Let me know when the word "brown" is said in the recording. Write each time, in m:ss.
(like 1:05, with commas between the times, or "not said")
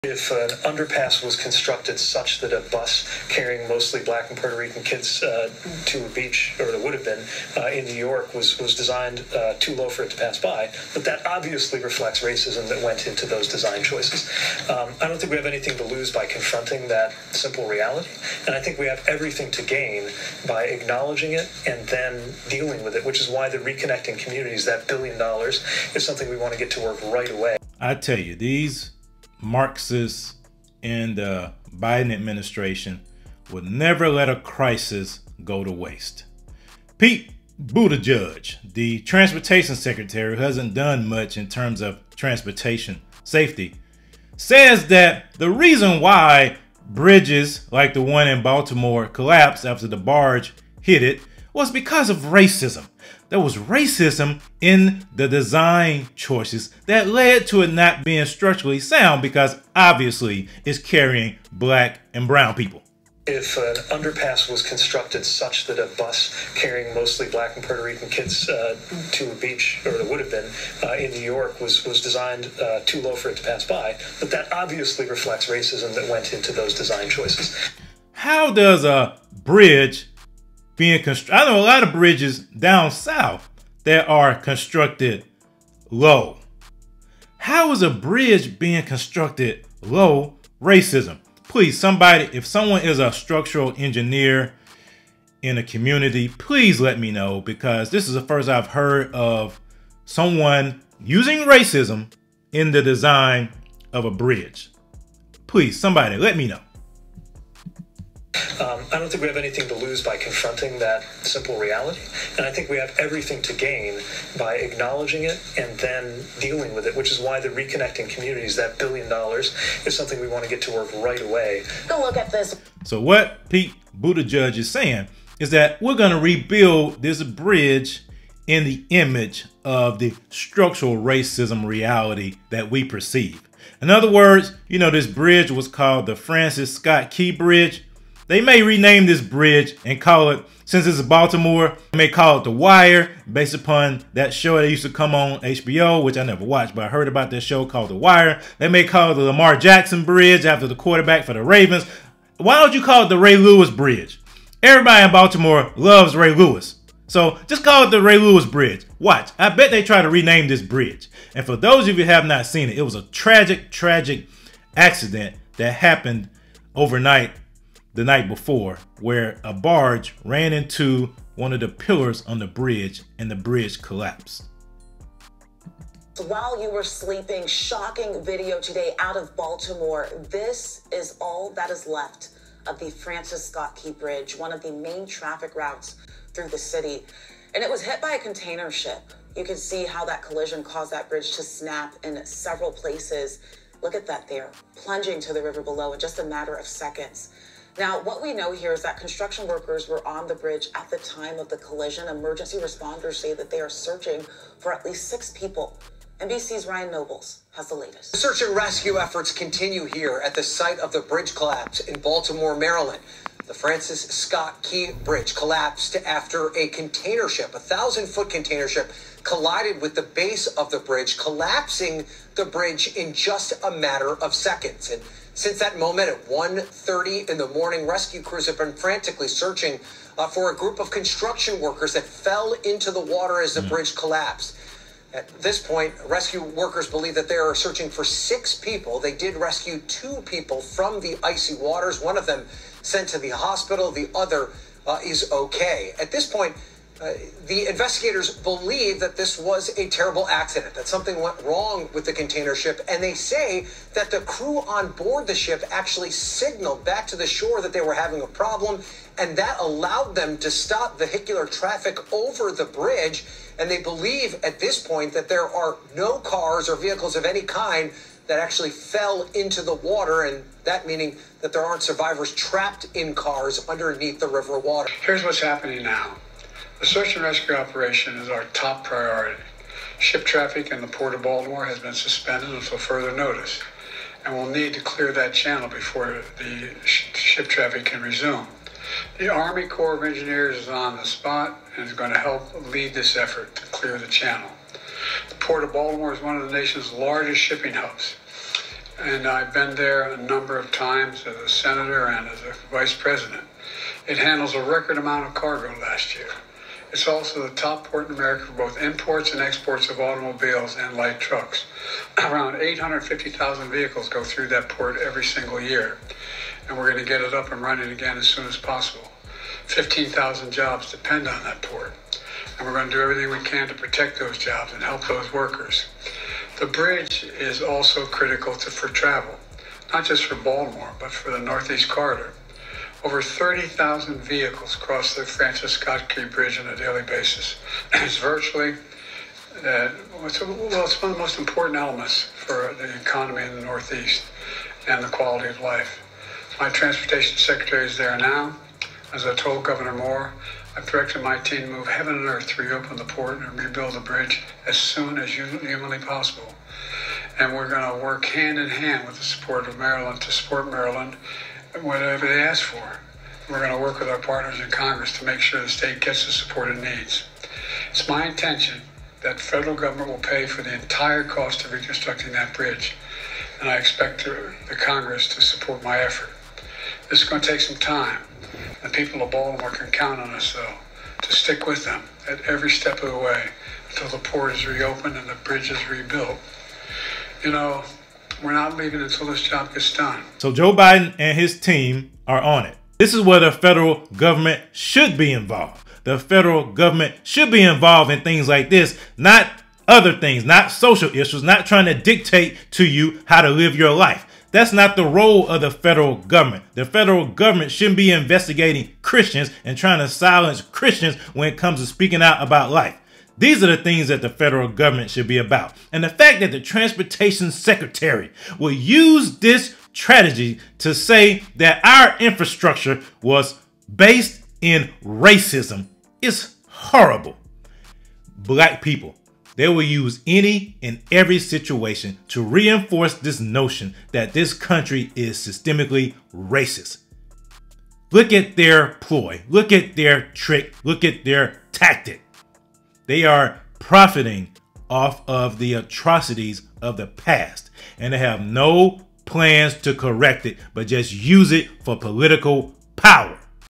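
1:02.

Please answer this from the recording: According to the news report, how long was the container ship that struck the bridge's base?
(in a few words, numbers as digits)
1,000 foot.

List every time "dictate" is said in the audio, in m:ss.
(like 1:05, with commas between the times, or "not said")
6:41.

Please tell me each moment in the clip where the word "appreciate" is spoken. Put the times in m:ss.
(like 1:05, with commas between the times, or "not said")
not said.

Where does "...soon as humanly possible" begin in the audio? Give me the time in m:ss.
5:54.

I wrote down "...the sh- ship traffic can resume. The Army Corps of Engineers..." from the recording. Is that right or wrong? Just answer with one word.
right.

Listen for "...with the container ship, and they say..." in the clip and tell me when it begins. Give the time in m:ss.
4:11.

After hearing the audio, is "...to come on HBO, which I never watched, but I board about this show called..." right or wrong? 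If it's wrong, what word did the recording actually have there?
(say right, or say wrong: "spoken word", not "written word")
wrong: "heard", not "board".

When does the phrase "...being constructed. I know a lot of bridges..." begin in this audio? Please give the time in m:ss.
1:20.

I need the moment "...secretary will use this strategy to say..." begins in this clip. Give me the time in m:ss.
6:57.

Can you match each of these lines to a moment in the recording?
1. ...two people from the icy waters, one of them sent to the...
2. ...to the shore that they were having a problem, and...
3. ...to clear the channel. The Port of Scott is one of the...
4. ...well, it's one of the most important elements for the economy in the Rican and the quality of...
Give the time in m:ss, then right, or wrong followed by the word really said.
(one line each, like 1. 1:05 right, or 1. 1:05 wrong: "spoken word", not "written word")
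1. 3:59 right
2. 4:17 right
3. 4:53 wrong: "Baltimore", not "Scott"
4. 5:40 wrong: "Northeast", not "Rican".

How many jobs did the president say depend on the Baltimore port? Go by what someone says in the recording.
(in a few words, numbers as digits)
15,000.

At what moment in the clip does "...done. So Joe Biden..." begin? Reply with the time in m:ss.
6:29.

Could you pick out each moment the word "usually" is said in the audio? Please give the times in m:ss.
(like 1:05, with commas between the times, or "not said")
not said.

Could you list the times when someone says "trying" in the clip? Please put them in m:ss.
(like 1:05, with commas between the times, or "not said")
6:41, 6:49.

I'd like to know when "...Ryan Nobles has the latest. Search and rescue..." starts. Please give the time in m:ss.
3:26.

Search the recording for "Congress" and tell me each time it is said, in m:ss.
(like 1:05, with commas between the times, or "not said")
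6:04, 6:14.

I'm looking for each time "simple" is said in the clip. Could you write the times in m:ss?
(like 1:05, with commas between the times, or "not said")
0:17, 1:51.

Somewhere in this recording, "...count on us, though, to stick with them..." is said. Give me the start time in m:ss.
6:19.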